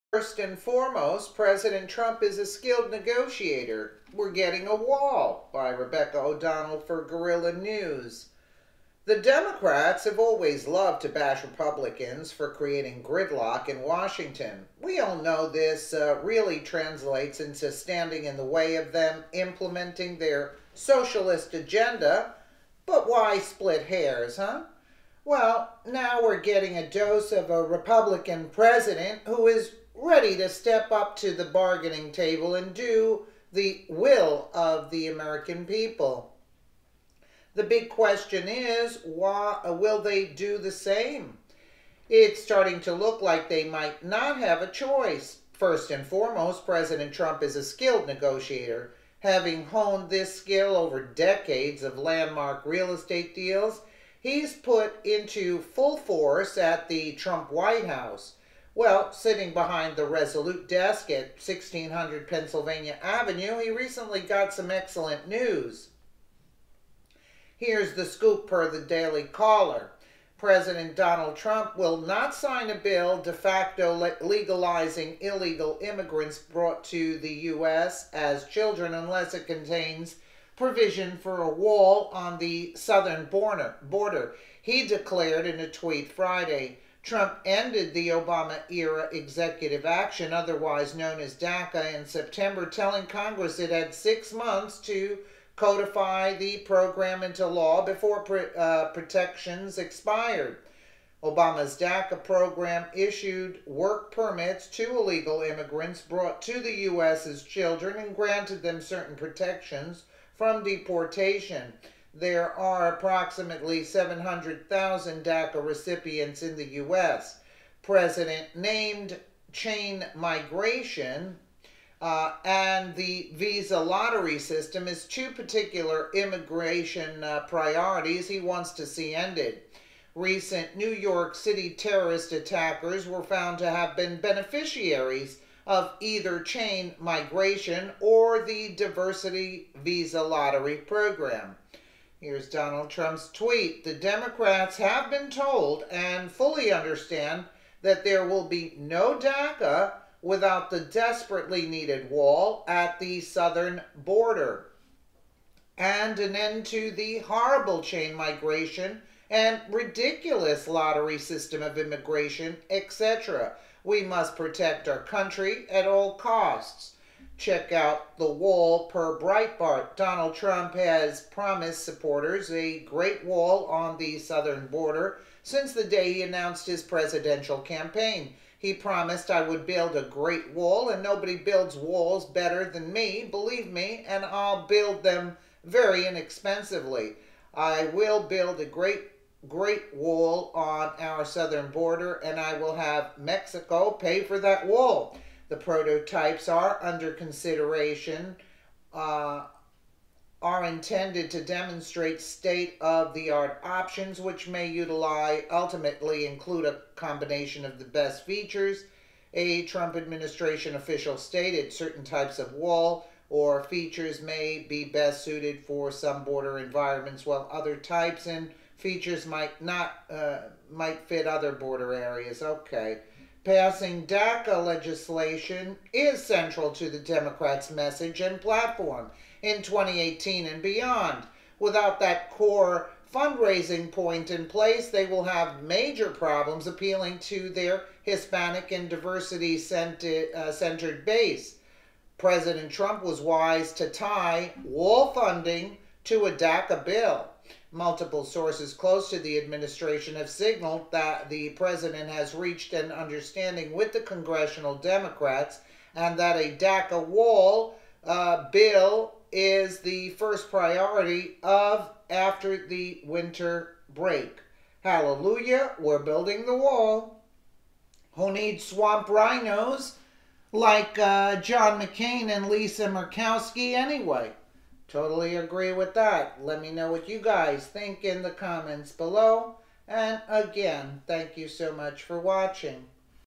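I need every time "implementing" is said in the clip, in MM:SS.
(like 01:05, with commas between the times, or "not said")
00:19.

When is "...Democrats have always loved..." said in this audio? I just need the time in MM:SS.
00:09.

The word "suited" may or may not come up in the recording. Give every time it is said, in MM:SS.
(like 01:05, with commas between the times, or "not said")
03:35.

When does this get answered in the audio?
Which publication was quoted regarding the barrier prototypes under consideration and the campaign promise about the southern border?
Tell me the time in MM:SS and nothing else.
02:49.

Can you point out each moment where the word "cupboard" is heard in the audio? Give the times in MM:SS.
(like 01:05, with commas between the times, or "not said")
not said.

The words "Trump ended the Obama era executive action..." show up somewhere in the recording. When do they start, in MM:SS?
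01:27.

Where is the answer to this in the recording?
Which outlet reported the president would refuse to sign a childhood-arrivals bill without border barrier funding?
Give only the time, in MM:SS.
01:08.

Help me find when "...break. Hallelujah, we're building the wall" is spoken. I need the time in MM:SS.
04:23.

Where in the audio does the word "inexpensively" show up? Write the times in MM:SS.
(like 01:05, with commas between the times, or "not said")
03:06.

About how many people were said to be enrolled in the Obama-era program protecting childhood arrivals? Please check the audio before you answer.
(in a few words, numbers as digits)
700,000.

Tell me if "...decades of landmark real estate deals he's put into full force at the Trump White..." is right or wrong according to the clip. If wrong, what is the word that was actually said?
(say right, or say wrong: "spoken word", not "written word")
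right.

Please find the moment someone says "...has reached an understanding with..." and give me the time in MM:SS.
04:12.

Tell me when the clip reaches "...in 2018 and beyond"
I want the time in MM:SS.
03:49.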